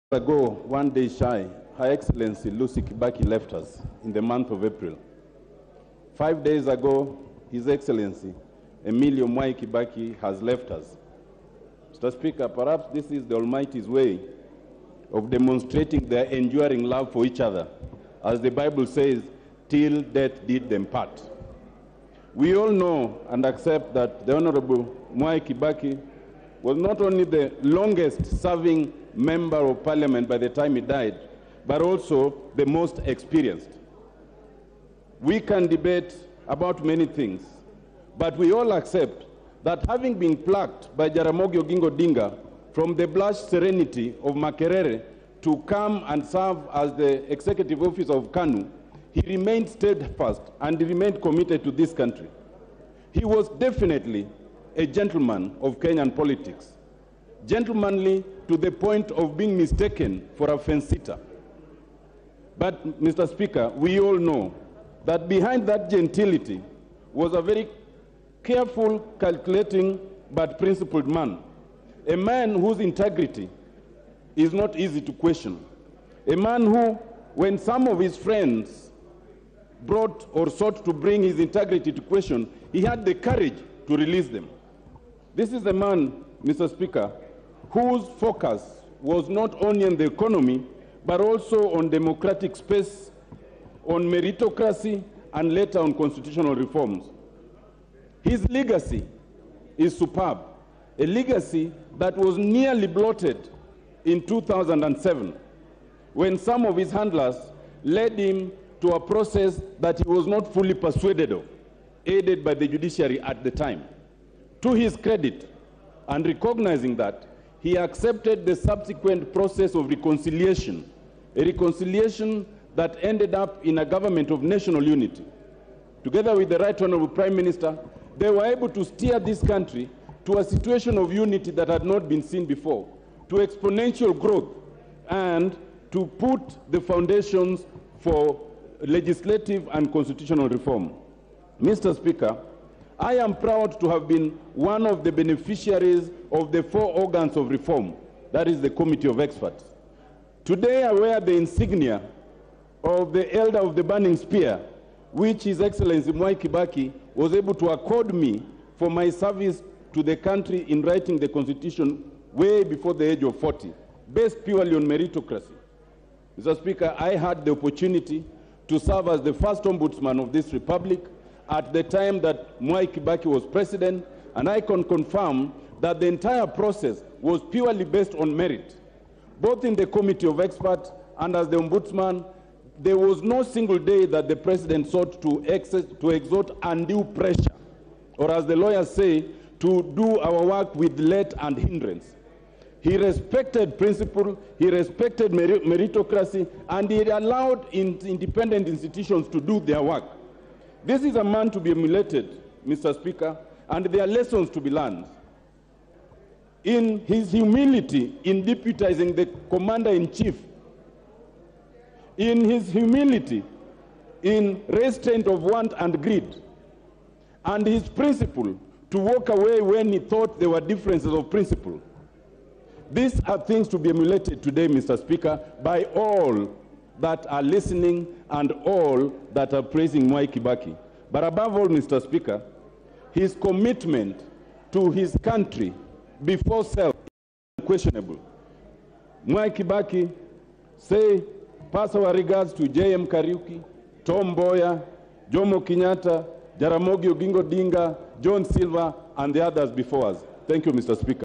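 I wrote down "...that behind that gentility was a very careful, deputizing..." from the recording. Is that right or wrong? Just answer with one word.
wrong.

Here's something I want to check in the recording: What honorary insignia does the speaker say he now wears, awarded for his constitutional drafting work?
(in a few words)
Elder of the Burning Spear.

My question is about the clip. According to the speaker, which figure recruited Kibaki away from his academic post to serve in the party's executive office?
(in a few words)
Jaramogi Oginga Odinga.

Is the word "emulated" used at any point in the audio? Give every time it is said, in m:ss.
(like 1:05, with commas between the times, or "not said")
3:21, 3:43.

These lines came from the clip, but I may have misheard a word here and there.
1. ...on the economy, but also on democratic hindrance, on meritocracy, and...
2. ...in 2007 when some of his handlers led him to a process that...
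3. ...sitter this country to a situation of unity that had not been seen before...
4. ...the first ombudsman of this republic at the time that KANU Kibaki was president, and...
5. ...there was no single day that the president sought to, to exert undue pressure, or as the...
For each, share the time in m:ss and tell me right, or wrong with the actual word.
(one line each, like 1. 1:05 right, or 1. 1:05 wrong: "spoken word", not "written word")
1. 1:29 wrong: "space", not "hindrance"
2. 1:44 right
3. 2:08 wrong: "steer", not "sitter"
4. 2:49 wrong: "Mwai", not "KANU"
5. 3:02 right.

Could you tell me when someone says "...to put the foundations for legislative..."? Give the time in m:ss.
2:15.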